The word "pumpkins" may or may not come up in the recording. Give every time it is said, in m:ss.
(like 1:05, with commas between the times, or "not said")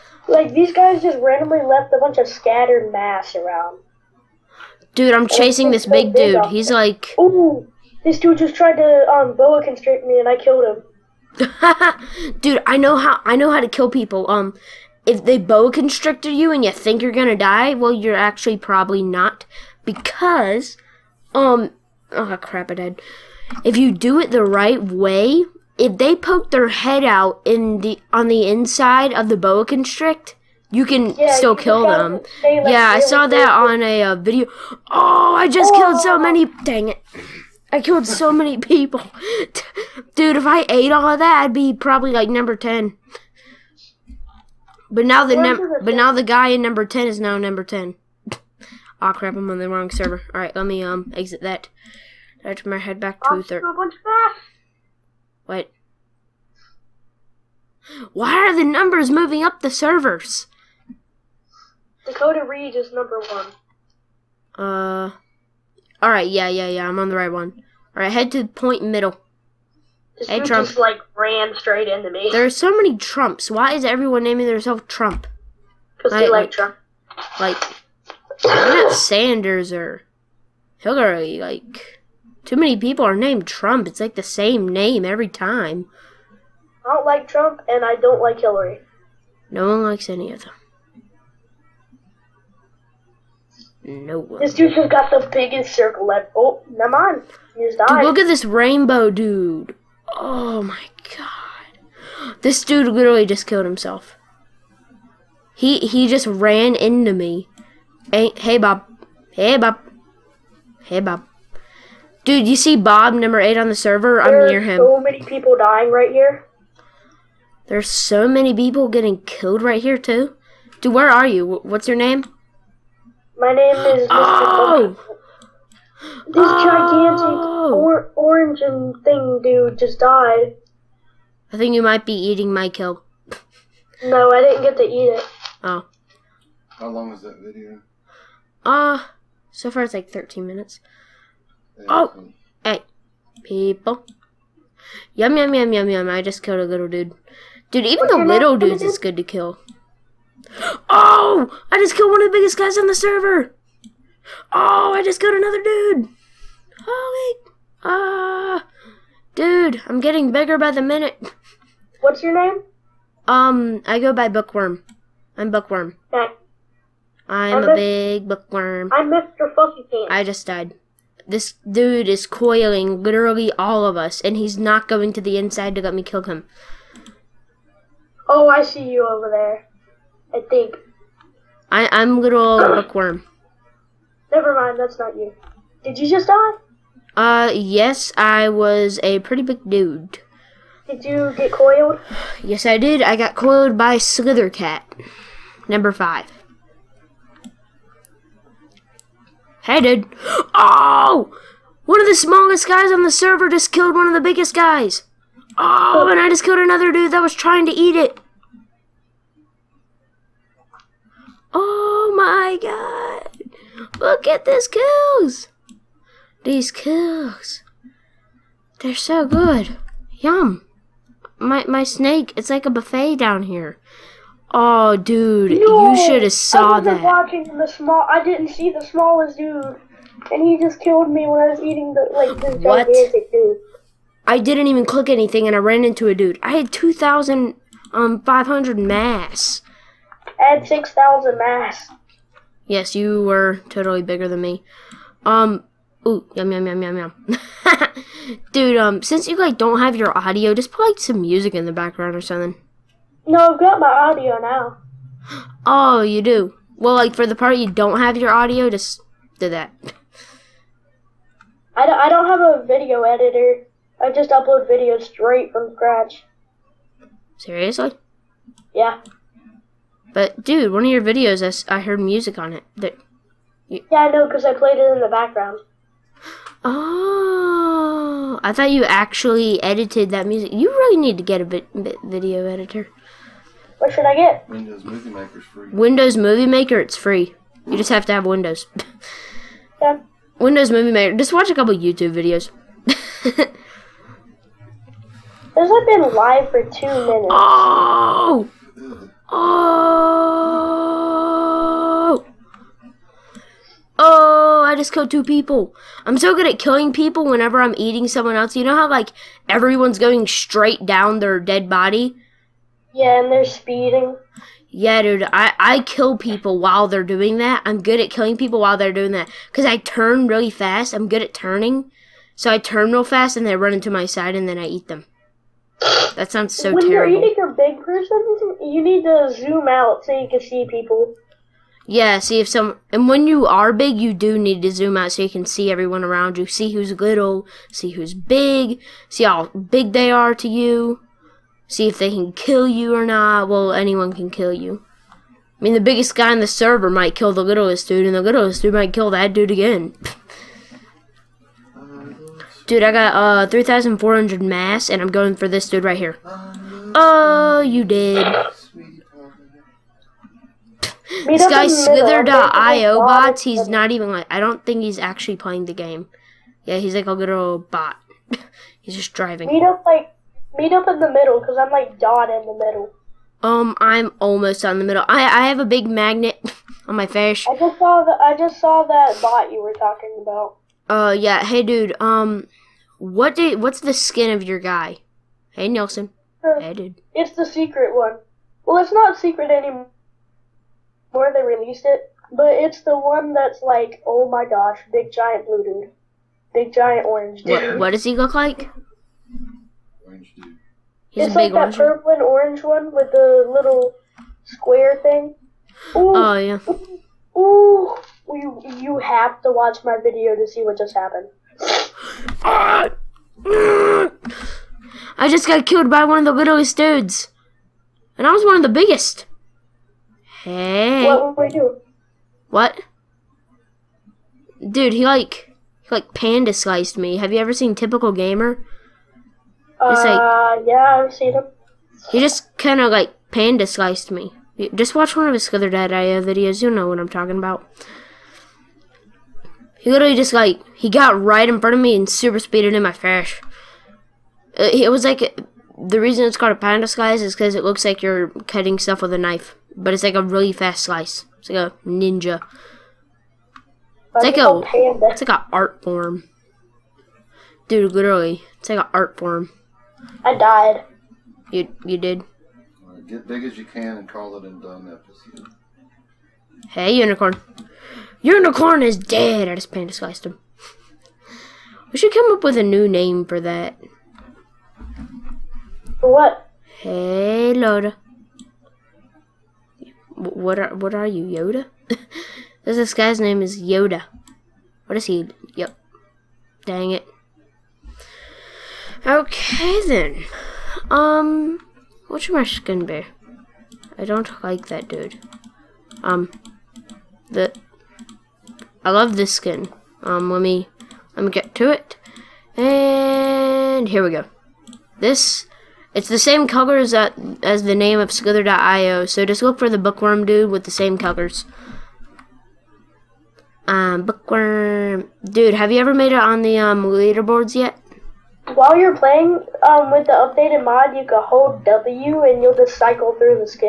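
not said.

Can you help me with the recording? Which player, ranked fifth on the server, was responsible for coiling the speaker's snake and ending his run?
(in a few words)
Slithercat.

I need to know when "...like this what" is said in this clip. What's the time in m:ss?
3:52.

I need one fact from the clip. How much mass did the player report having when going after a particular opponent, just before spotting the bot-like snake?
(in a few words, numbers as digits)
3,400.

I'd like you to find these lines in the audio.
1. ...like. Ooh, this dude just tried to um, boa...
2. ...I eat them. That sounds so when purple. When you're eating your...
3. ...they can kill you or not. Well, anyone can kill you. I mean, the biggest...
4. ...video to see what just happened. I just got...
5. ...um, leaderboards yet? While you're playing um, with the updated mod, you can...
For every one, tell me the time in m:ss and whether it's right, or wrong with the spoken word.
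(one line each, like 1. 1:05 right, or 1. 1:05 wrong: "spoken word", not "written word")
1. 0:06 right
2. 5:24 wrong: "terrible", not "purple"
3. 5:41 right
4. 6:50 right
5. 8:36 right.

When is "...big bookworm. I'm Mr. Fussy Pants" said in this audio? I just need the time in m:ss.
2:47.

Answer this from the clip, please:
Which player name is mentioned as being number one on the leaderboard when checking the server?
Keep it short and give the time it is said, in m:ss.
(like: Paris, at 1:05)
Dakota Reed, at 1:02.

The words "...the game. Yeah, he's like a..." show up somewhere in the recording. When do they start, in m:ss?
6:05.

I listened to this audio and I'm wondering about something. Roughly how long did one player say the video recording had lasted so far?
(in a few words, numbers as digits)
13 minutes.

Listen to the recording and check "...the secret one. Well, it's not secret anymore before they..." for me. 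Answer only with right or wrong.
right.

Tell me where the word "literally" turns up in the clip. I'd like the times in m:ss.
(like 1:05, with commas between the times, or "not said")
1:42, 2:53, 7:19, 7:37.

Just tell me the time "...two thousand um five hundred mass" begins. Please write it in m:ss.
3:56.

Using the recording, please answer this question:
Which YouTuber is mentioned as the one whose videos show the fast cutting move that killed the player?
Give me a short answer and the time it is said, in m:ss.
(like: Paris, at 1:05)
Typical Gamer, at 7:07.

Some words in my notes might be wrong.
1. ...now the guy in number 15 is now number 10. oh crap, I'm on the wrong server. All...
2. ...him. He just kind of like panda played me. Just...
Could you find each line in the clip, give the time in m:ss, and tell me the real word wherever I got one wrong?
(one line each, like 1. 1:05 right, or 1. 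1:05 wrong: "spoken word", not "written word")
1. 0:45 wrong: "10", not "15"
2. 7:11 wrong: "sliced", not "played".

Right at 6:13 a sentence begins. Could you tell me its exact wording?
Um, I'm almost on the middle.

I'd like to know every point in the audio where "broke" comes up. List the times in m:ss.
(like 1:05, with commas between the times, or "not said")
not said.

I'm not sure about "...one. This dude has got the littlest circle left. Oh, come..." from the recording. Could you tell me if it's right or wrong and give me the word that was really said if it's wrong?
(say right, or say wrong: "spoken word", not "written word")
wrong: "biggest", not "littlest".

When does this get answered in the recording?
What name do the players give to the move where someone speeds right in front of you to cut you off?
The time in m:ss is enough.
7:26.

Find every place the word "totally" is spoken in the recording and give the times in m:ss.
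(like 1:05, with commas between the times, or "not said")
4:03.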